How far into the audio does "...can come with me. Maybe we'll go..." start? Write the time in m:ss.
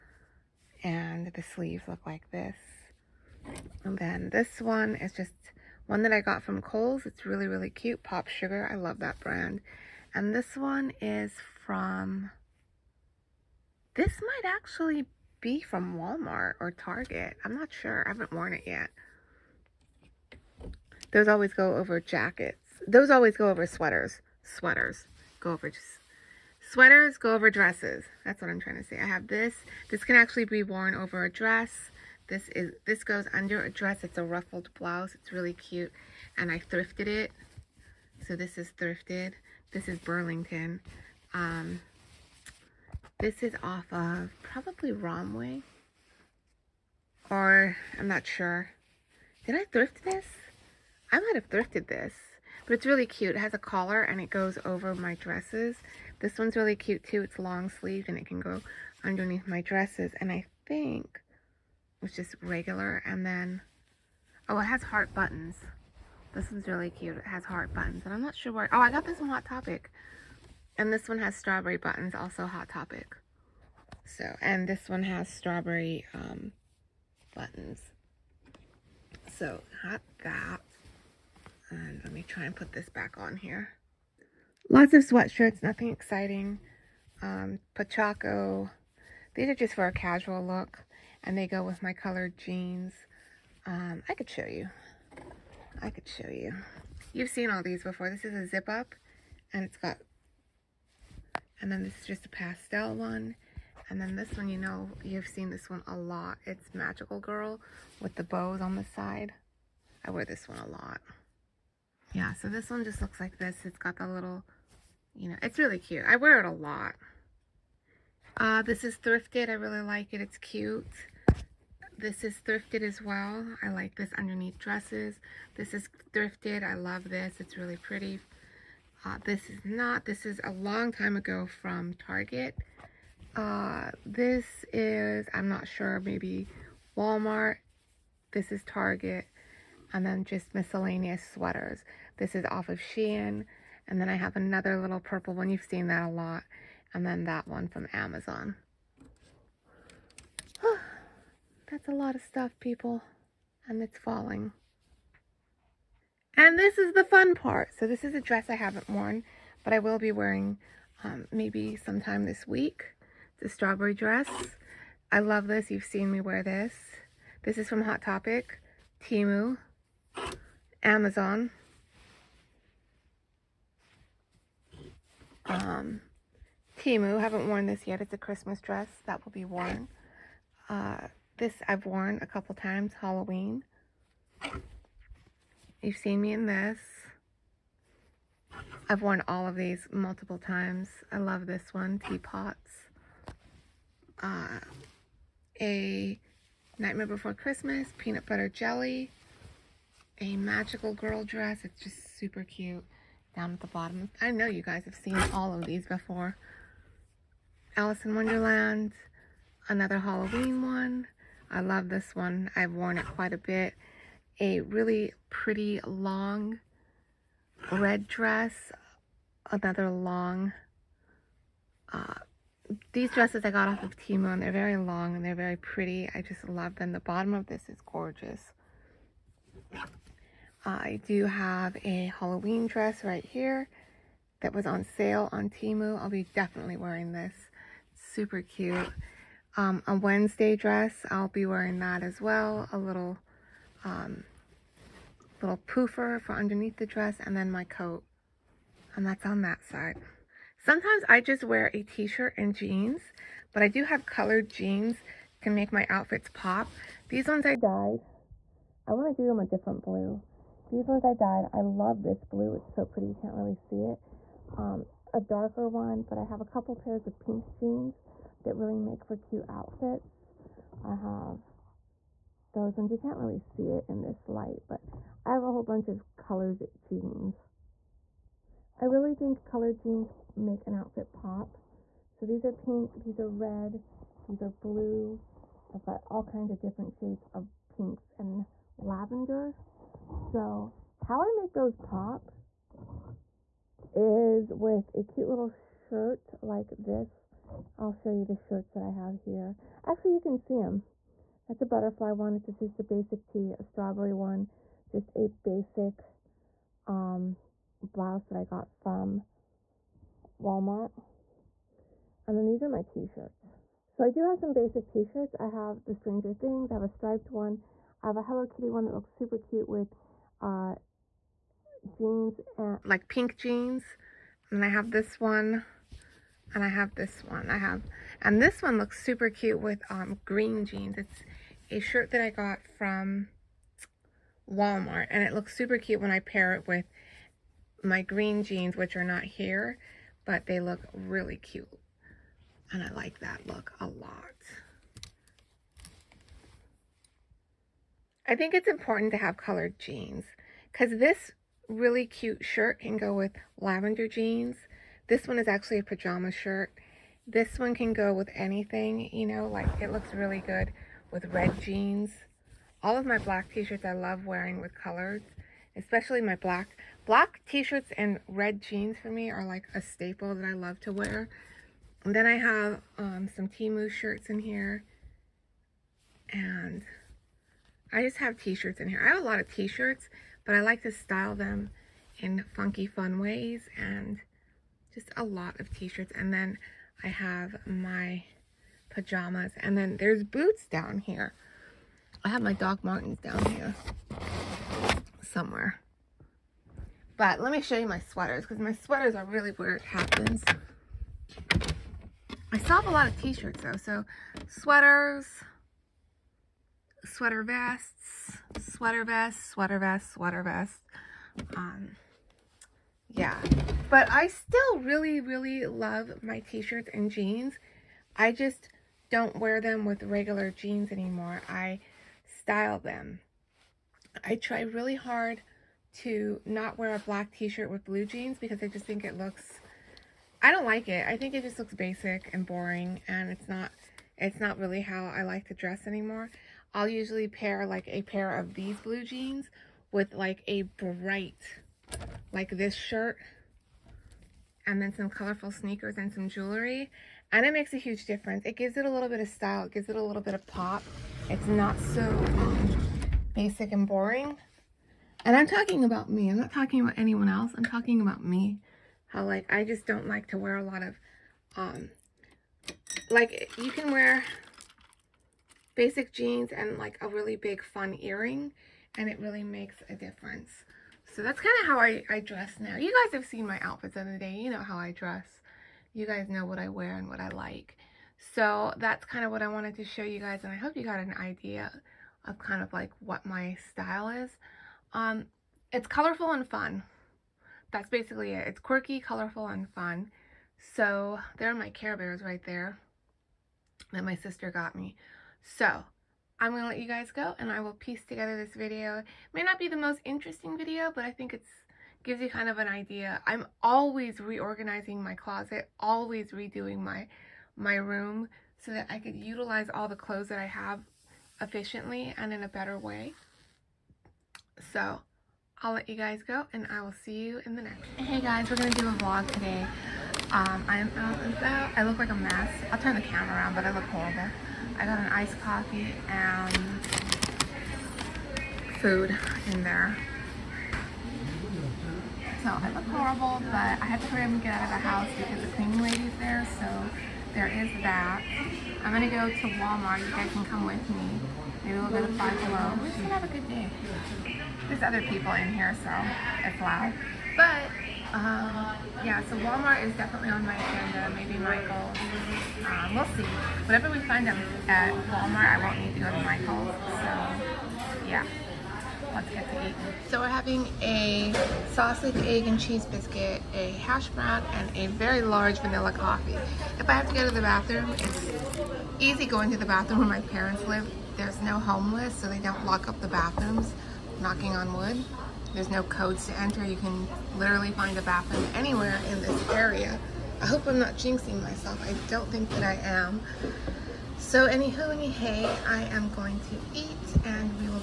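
9:00.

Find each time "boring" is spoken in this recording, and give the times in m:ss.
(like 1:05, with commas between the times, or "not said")
7:12, 7:33.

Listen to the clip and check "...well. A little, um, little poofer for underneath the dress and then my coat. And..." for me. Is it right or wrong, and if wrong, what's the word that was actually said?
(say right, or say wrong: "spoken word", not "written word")
right.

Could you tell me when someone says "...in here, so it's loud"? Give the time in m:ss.
9:05.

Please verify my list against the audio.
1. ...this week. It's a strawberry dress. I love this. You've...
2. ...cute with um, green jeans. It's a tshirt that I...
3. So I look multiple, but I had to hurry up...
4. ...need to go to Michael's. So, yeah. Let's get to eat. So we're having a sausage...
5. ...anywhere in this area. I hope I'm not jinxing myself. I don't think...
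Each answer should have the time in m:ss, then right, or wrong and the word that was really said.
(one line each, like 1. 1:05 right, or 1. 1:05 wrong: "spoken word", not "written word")
1. 2:42 right
2. 5:29 wrong: "shirt", not "tshirt"
3. 8:52 wrong: "horrible", not "multiple"
4. 9:15 right
5. 9:38 right.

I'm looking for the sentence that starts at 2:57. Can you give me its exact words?
It's a Christmas dress that will be worn.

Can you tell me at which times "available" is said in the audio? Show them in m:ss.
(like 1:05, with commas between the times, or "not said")
not said.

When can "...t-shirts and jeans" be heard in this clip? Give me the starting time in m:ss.
6:56.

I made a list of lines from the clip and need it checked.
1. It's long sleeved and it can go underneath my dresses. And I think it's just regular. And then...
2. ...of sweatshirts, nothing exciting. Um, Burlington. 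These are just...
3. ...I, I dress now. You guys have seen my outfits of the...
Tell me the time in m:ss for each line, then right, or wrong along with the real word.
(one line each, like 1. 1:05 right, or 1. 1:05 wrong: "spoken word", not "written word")
1. 0:57 right
2. 1:24 wrong: "Pachaco", not "Burlington"
3. 7:51 right.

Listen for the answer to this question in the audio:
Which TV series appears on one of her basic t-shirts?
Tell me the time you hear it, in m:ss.
5:15.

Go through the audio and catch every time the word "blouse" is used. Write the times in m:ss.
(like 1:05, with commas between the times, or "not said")
0:34, 5:07.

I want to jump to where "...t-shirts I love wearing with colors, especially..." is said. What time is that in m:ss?
6:03.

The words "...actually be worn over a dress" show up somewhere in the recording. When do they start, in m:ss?
0:30.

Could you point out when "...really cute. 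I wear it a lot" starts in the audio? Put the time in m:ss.
1:55.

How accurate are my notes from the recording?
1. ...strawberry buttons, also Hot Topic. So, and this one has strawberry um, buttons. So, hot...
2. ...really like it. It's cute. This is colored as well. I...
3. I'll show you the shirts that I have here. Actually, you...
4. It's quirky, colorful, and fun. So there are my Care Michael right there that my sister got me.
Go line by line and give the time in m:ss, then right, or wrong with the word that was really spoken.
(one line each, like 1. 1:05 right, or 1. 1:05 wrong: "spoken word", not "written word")
1. 1:11 right
2. 1:59 wrong: "thrifted", not "colored"
3. 4:57 right
4. 8:08 wrong: "Bears", not "Michael".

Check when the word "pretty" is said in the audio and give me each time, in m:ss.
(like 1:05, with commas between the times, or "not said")
2:07, 3:35, 3:45, 4:22.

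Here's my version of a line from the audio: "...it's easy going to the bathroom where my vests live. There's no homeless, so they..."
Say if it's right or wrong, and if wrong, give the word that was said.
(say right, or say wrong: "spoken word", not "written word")
wrong: "parents", not "vests".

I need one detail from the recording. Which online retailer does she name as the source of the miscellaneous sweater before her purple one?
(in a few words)
Shein.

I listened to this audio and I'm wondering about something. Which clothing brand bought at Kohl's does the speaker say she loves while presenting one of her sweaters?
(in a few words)
Pop Sugar.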